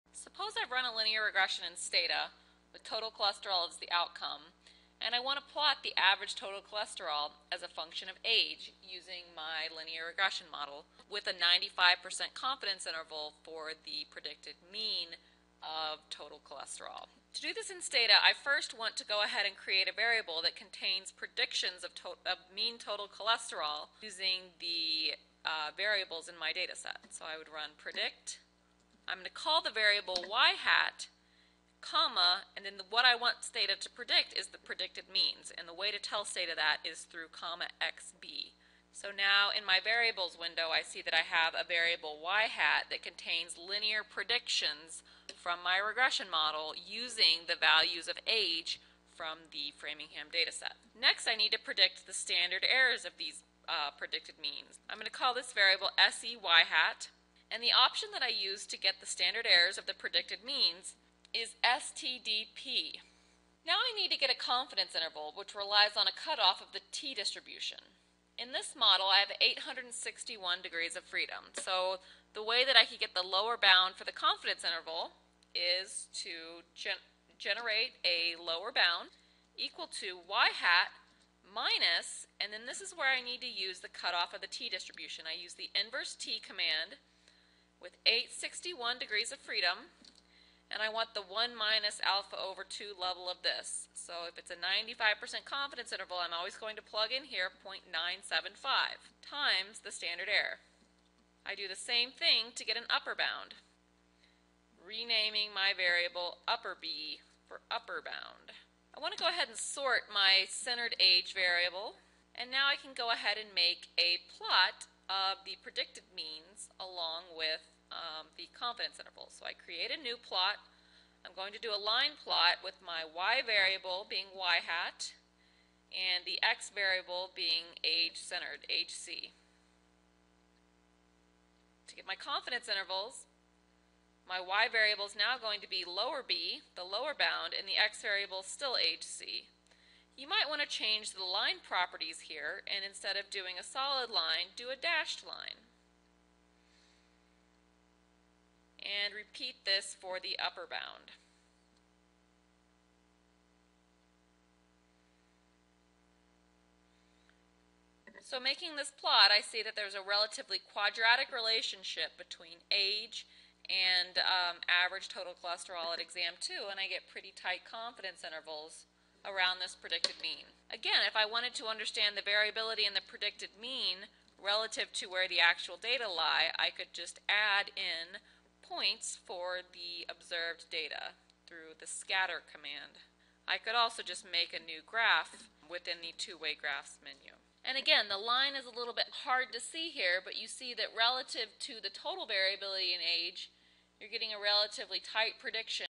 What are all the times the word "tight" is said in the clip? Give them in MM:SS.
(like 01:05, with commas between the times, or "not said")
02:47, 03:15.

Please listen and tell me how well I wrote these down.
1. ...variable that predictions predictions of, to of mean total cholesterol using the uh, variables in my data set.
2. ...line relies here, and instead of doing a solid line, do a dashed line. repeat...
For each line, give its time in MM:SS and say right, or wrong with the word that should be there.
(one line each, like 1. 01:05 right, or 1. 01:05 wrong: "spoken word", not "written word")
1. 00:19 wrong: "contains", not "predictions"
2. 02:21 wrong: "properties", not "relies".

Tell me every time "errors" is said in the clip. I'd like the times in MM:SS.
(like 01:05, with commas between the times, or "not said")
00:52, 00:59, 01:40.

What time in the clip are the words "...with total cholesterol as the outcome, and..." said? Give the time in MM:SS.
00:02.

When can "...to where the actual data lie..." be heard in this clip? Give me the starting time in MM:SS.
02:55.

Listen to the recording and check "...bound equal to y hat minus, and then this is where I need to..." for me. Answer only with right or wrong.
right.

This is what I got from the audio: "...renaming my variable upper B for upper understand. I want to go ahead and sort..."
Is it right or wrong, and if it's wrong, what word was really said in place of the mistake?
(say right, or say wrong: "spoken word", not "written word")
wrong: "bound", not "understand".